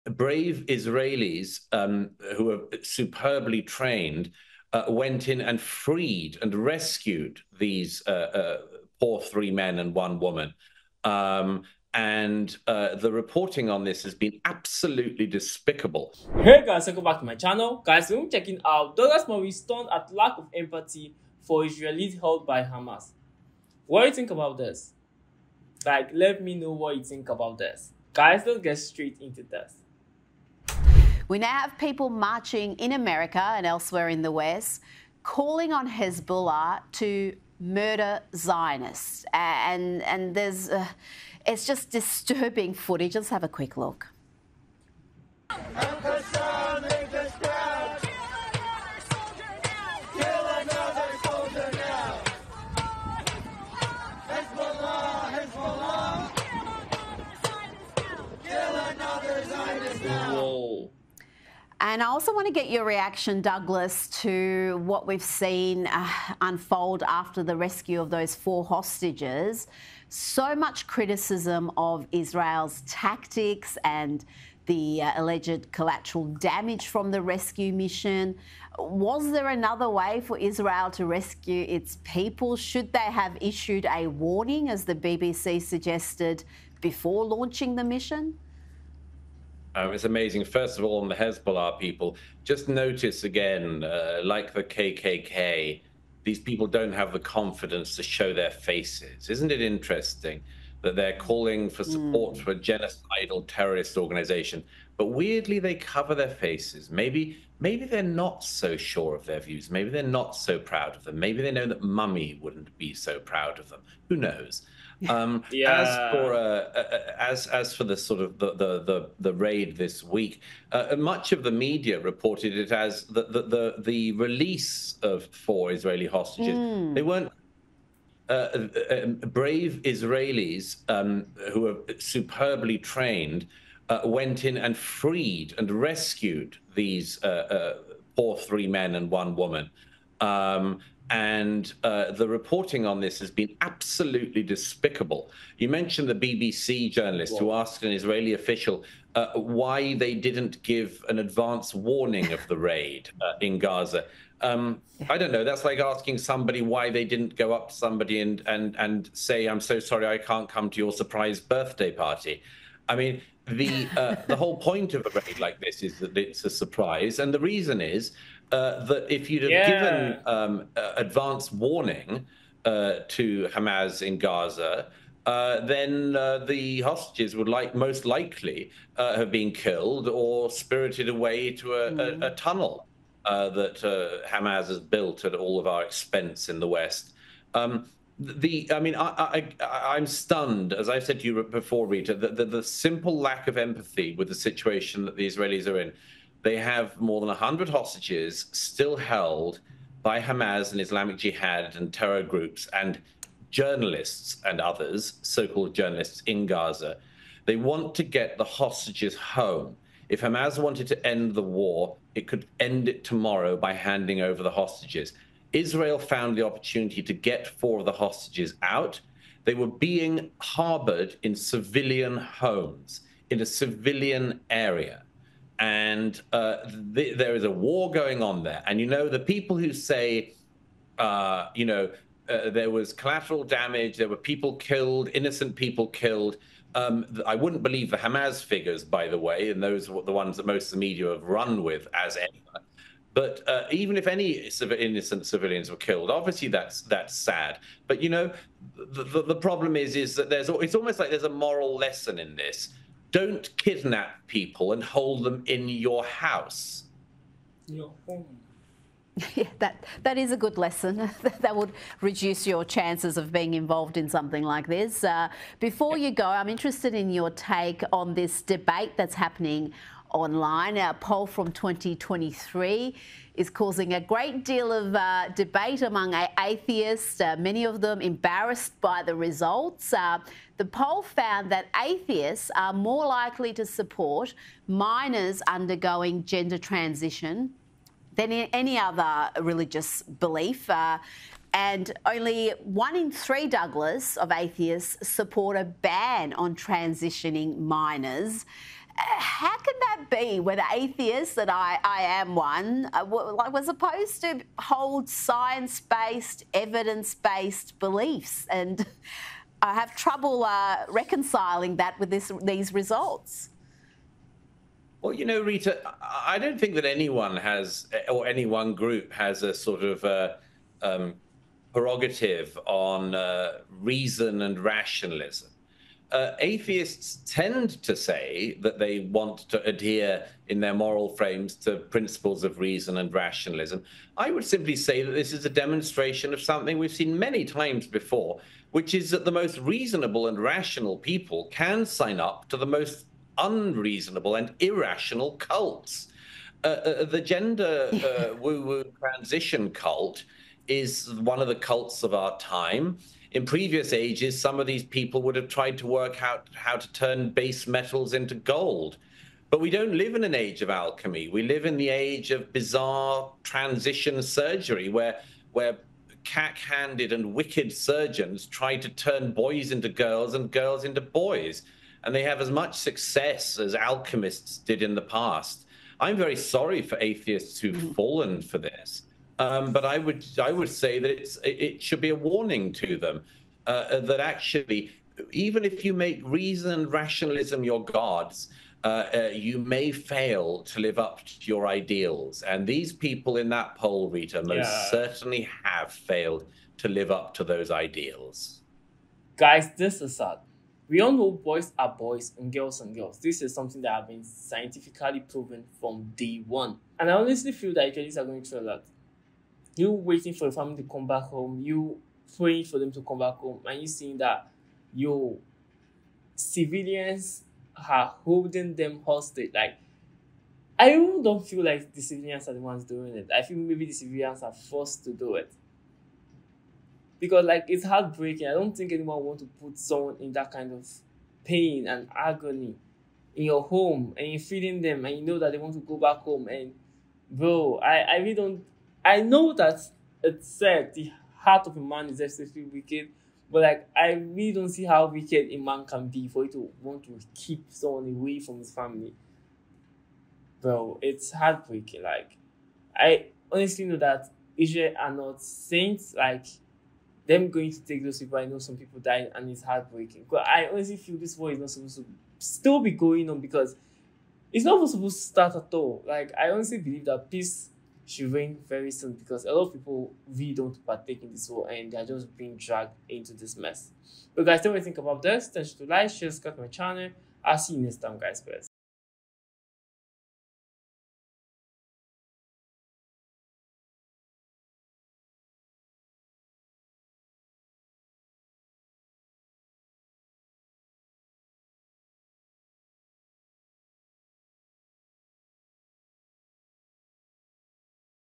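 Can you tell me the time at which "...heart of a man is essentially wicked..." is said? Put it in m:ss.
7:21.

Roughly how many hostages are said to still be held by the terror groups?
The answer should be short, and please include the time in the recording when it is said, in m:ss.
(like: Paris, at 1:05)
more than 100, at 3:16.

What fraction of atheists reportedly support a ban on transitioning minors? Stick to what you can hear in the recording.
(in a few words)
one in three.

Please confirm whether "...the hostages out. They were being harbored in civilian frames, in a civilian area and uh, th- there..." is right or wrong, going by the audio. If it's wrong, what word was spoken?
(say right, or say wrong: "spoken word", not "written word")
wrong: "homes", not "frames".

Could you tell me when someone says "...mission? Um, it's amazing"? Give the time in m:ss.
1:27.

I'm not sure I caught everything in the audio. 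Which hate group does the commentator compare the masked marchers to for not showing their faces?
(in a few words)
KKK.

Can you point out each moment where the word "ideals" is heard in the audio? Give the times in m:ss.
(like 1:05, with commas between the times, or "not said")
6:31, 6:37.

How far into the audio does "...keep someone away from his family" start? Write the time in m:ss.
7:27.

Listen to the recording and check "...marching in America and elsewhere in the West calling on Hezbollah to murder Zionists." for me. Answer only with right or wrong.
right.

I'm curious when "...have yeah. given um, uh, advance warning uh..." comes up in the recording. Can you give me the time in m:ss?
2:49.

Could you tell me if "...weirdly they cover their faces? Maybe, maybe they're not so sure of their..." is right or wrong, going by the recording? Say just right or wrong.
right.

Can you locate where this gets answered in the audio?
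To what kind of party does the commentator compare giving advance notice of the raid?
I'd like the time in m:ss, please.
2:40.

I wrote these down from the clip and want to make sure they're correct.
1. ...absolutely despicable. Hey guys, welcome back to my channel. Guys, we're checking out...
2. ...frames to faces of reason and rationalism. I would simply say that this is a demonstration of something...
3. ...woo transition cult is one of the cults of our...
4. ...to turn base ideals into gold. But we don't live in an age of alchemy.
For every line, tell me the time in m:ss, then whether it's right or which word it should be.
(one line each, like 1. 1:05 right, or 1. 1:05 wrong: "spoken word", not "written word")
1. 0:14 right
2. 5:31 wrong: "principles", not "faces"
3. 5:48 right
4. 5:56 wrong: "metals", not "ideals".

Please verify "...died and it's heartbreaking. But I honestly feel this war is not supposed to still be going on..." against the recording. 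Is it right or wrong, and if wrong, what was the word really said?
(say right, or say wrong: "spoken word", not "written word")
right.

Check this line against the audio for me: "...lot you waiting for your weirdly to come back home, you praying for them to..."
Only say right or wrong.
wrong.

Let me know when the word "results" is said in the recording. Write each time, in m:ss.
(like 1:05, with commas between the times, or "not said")
4:39, 5:12.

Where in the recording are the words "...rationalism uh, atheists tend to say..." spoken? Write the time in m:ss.
5:24.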